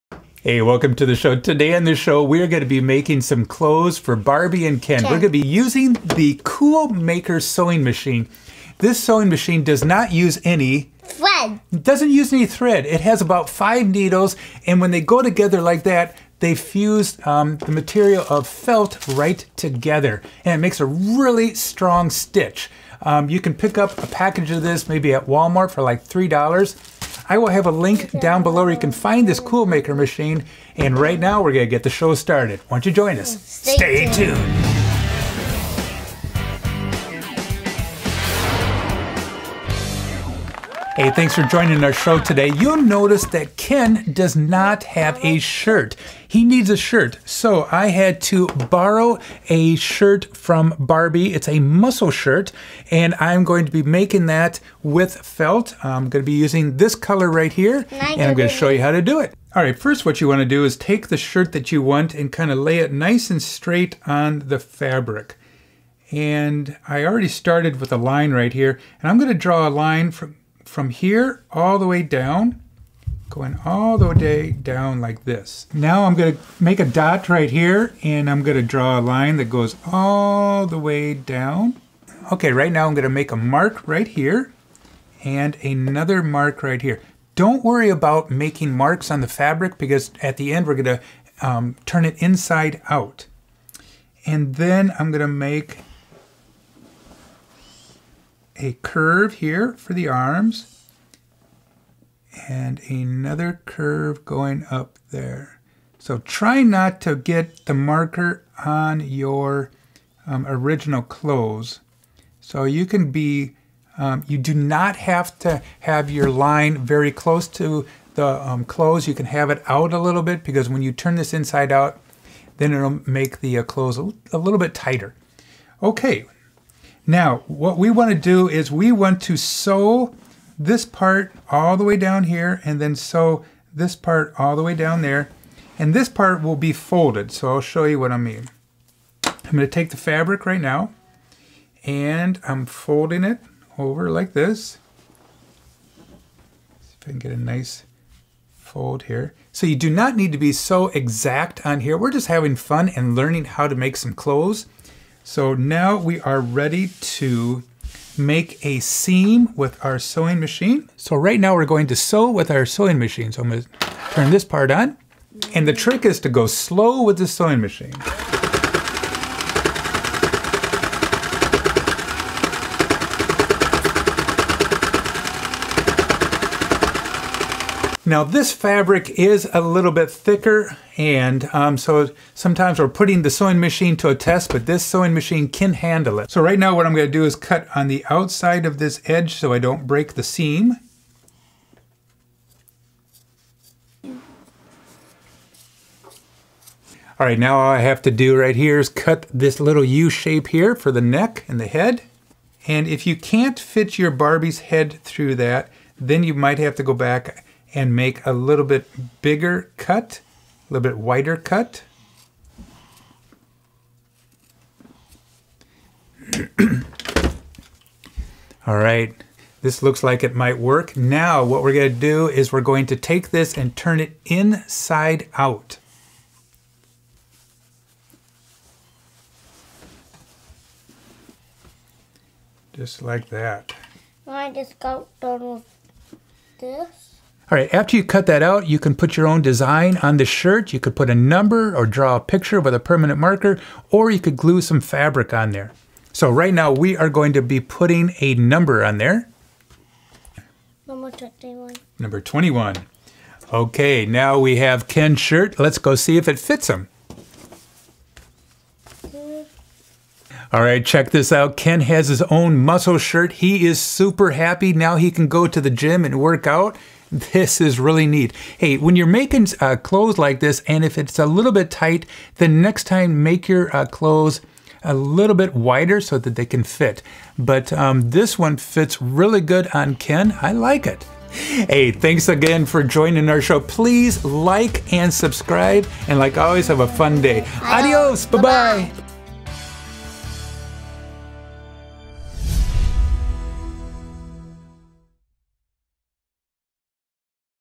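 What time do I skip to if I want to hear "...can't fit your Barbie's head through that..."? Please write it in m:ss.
3:23.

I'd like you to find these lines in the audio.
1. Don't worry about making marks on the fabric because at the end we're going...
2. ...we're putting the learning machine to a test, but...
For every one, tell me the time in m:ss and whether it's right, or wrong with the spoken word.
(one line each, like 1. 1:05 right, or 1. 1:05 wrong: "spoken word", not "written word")
1. 1:27 right
2. 3:02 wrong: "sewing", not "learning".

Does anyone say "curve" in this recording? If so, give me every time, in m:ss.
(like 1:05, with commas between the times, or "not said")
1:38, 1:43.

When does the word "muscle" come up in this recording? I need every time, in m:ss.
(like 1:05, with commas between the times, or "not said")
0:51, 4:22.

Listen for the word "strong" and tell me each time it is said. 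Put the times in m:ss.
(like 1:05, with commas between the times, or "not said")
0:21.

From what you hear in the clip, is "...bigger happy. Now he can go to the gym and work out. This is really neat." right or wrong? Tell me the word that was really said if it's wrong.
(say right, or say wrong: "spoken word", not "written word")
wrong: "super", not "bigger".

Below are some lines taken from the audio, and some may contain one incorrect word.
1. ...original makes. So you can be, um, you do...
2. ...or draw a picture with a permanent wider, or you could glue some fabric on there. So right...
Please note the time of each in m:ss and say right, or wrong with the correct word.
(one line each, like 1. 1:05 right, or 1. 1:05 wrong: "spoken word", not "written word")
1. 1:50 wrong: "clothes", not "makes"
2. 4:01 wrong: "marker", not "wider".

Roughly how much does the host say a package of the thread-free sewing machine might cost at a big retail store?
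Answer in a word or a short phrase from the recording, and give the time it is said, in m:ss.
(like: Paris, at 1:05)
$3, at 0:26.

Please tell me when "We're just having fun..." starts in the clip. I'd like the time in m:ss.
2:31.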